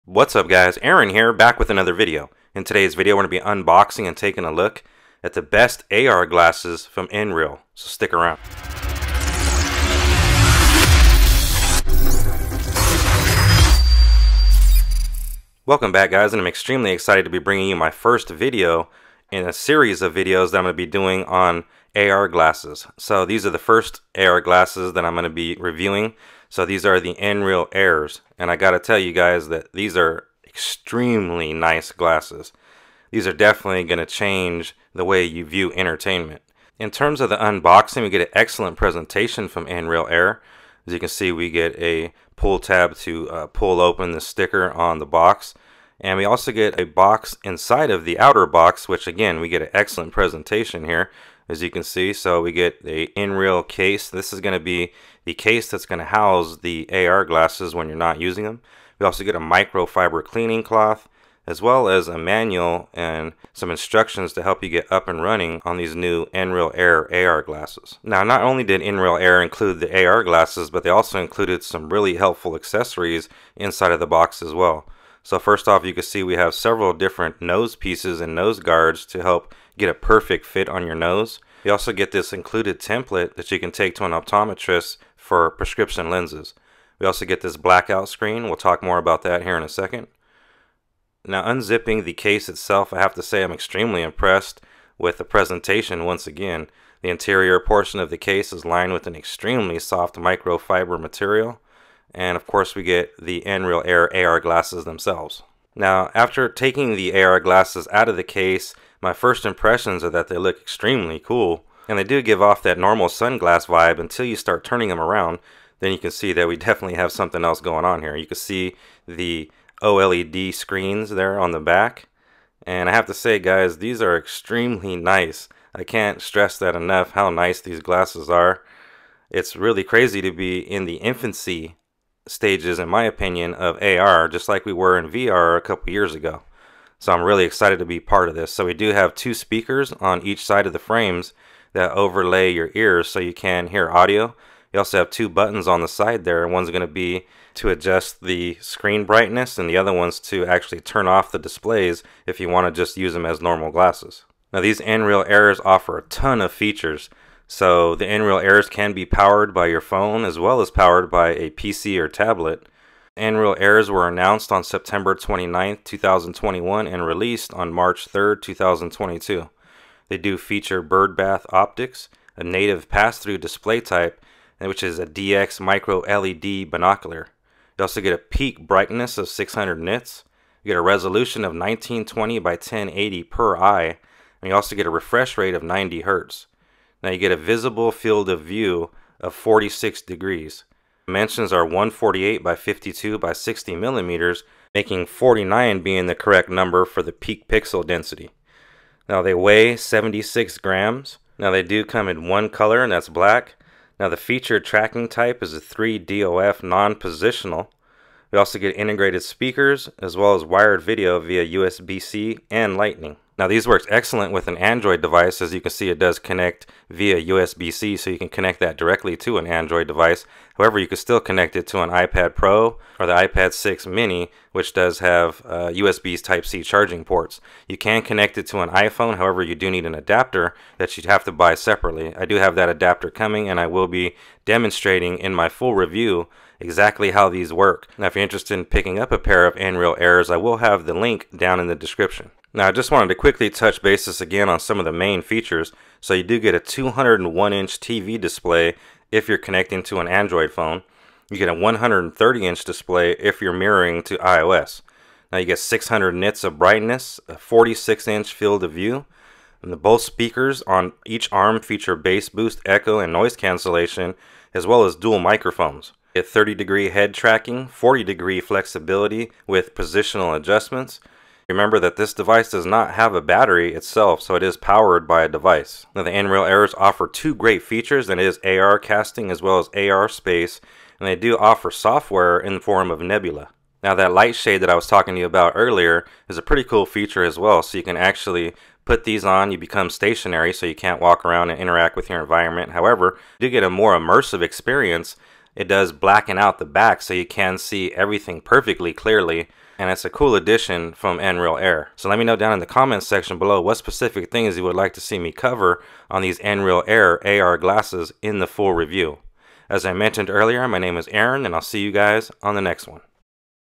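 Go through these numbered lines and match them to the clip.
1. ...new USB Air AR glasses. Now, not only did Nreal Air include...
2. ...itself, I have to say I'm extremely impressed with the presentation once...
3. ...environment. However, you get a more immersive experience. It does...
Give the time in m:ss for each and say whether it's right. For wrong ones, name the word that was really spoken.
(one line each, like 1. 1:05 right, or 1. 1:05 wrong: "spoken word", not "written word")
1. 1:05 wrong: "Nreal", not "USB"
2. 1:32 right
3. 4:52 right.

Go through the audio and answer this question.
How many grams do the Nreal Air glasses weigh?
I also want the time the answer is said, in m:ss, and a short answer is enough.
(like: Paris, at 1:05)
76 grams, at 3:19.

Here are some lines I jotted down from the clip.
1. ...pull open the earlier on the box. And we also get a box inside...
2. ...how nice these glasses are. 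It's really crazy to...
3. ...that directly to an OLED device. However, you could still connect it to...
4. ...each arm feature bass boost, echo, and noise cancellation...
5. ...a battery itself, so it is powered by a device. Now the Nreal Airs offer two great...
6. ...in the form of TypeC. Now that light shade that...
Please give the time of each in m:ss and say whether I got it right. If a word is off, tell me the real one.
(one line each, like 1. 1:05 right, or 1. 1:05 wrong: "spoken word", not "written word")
1. 0:43 wrong: "sticker", not "earlier"
2. 2:07 right
3. 3:38 wrong: "Android", not "OLED"
4. 4:21 right
5. 4:33 right
6. 4:42 wrong: "Nebula", not "TypeC".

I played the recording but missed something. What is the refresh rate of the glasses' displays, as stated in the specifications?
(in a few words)
90 hertz.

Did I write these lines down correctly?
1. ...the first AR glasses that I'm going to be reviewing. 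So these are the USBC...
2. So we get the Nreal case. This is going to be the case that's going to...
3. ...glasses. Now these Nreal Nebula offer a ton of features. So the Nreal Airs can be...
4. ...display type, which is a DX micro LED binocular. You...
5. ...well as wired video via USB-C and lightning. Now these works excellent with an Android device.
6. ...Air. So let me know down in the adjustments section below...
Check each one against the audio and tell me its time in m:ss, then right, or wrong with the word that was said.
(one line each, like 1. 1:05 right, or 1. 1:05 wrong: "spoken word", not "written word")
1. 0:23 wrong: "Nreal", not "USBC"
2. 0:52 right
3. 2:33 wrong: "Airs", not "Nebula"
4. 2:53 right
5. 3:30 right
6. 5:01 wrong: "comments", not "adjustments".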